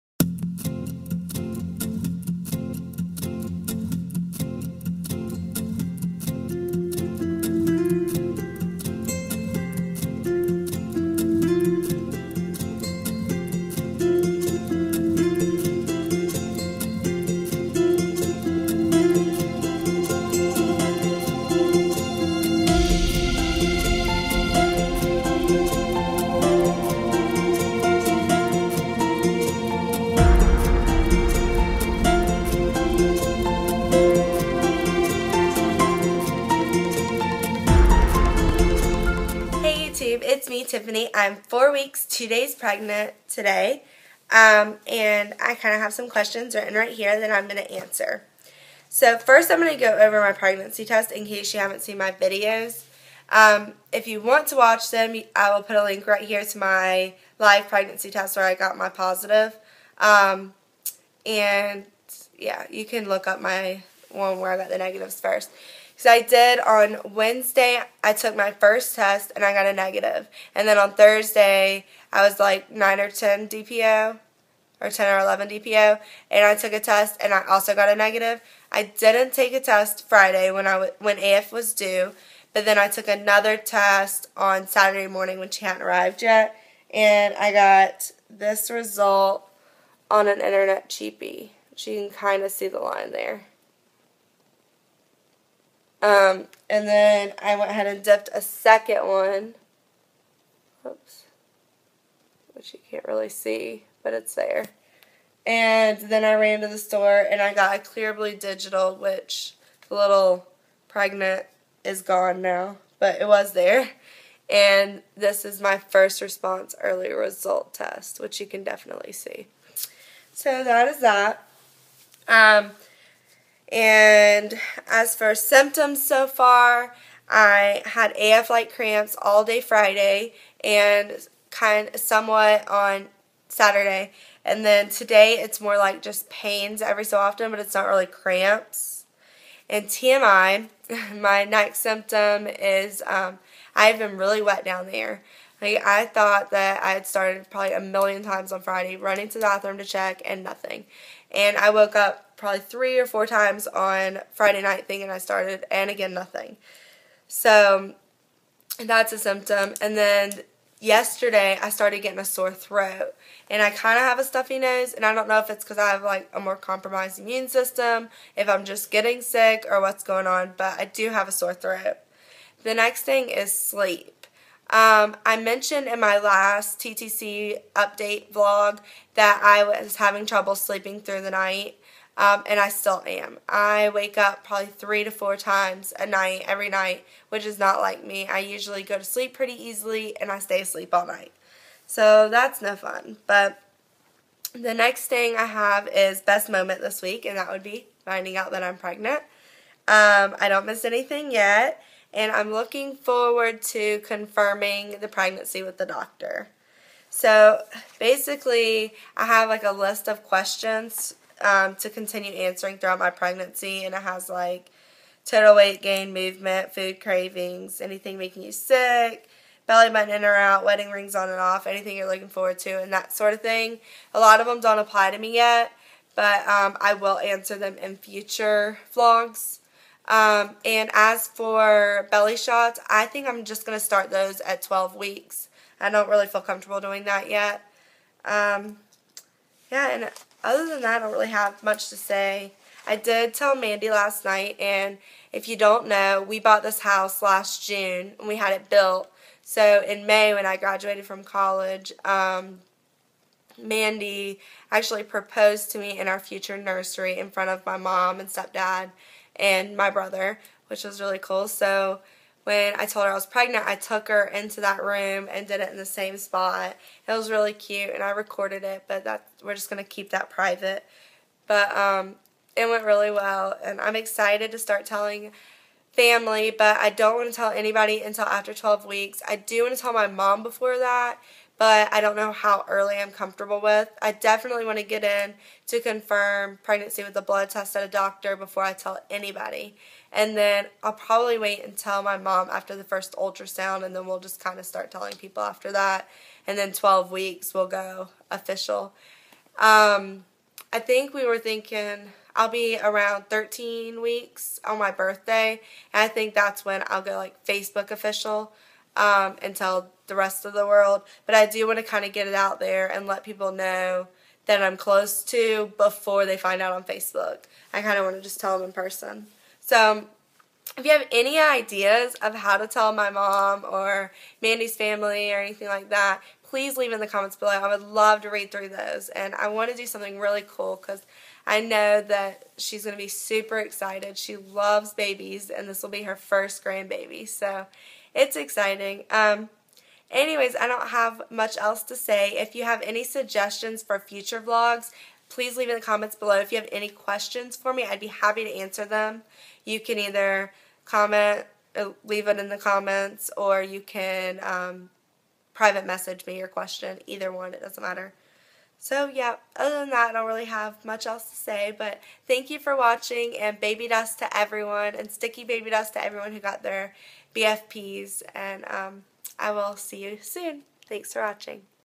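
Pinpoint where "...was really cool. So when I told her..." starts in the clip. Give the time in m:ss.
4:20.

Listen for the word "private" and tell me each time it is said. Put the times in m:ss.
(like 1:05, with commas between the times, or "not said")
4:30, 5:55.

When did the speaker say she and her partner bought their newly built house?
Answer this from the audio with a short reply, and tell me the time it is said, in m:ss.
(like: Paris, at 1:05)
last June, at 4:07.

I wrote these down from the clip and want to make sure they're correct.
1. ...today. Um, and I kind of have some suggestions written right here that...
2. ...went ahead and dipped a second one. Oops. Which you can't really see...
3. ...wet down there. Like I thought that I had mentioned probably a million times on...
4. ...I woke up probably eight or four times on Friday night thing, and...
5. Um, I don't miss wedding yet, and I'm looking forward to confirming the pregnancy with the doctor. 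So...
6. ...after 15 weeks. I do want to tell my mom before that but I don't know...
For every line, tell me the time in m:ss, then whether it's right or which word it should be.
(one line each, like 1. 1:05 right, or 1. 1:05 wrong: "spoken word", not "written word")
1. 0:43 wrong: "questions", not "suggestions"
2. 1:37 right
3. 2:24 wrong: "started", not "mentioned"
4. 2:31 wrong: "three", not "eight"
5. 3:19 wrong: "anything", not "wedding"
6. 4:38 wrong: "12", not "15".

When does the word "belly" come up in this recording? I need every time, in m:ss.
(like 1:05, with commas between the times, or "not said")
3:39, 3:52.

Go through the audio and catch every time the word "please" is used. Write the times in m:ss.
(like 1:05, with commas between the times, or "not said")
5:26, 5:45.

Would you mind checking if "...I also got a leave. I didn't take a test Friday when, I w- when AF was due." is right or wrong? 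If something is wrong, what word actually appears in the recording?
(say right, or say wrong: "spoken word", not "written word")
wrong: "negative", not "leave".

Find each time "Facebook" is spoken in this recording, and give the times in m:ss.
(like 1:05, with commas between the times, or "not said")
5:07, 5:16.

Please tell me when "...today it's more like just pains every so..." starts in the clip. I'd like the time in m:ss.
2:14.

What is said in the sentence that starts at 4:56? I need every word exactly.
And then 12 weeks will go official.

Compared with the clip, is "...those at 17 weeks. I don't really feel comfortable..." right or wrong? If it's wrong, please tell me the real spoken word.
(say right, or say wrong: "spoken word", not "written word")
wrong: "12", not "17".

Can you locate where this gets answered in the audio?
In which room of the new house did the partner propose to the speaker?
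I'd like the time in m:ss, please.
4:16.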